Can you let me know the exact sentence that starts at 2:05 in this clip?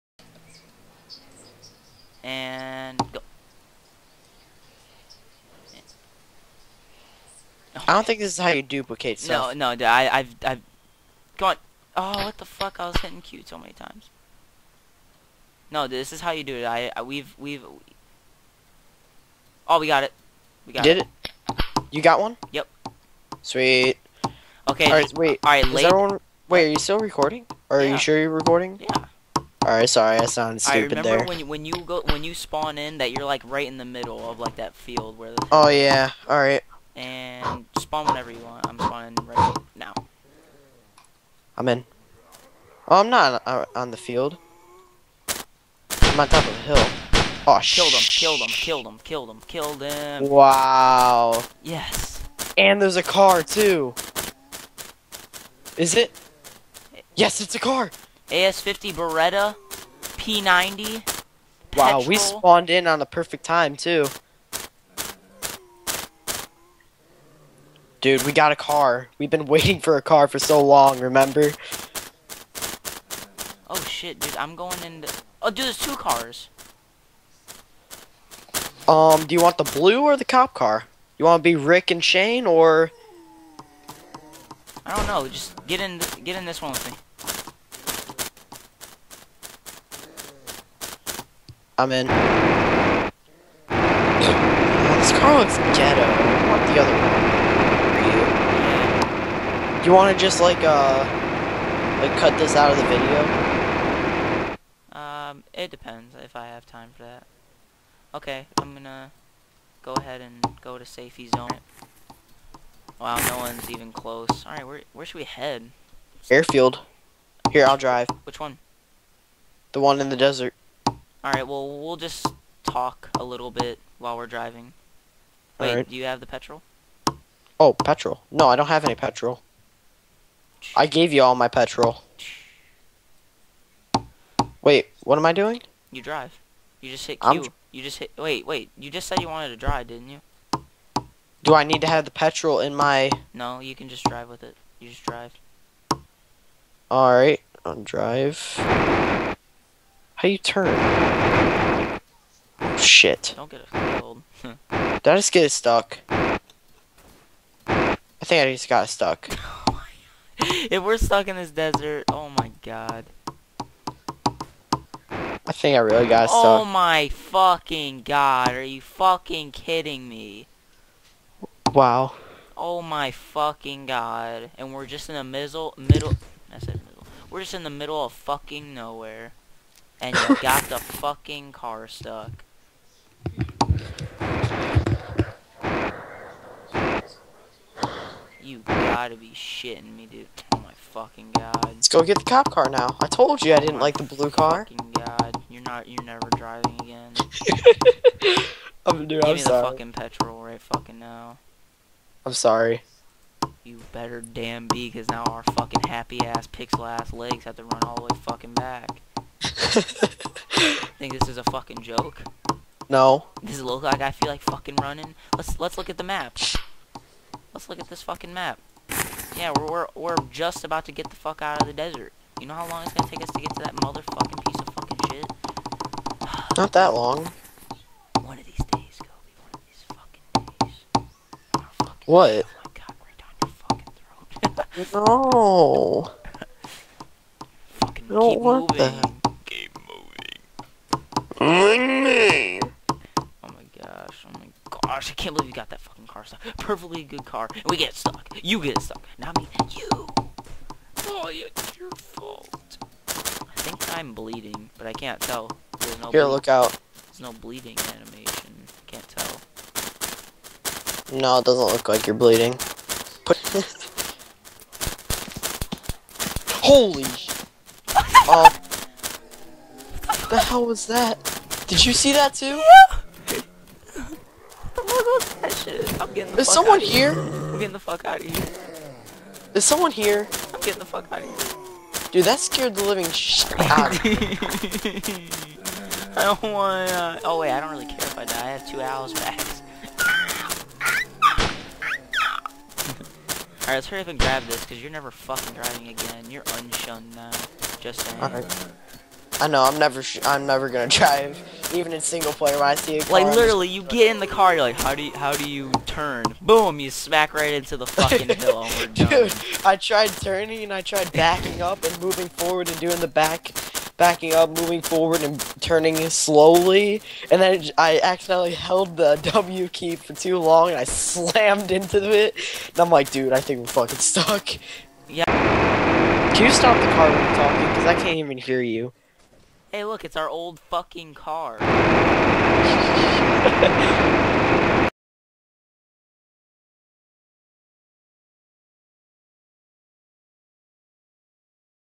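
Wait, do you have the petrol?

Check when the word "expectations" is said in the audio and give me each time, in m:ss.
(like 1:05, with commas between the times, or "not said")
not said.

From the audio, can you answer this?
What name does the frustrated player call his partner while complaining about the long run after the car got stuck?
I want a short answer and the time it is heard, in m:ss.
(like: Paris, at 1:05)
Cobi, at 3:48.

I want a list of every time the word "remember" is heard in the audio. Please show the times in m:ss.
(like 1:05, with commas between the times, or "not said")
0:31, 1:10.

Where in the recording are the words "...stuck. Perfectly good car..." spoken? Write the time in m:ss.
4:06.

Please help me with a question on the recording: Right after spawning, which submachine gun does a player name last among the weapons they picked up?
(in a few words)
P90.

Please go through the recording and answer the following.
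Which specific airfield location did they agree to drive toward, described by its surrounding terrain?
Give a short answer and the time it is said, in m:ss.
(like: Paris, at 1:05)
The one in the desert, at 1:59.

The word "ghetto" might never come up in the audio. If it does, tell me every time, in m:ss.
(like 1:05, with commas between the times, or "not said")
1:35.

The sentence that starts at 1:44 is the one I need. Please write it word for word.
Um, it depends if I have time for that.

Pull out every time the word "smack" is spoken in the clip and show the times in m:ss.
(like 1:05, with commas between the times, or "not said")
5:06.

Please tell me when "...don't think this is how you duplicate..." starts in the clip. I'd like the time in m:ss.
0:07.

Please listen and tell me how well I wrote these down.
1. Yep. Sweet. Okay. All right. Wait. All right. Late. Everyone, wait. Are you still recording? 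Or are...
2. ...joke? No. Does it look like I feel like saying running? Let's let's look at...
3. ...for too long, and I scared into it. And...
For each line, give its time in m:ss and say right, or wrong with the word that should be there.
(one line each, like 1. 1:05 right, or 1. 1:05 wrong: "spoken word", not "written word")
1. 0:22 right
2. 3:31 wrong: "fucking", not "saying"
3. 5:19 wrong: "slammed", not "scared".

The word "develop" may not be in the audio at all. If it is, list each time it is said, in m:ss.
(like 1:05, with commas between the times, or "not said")
not said.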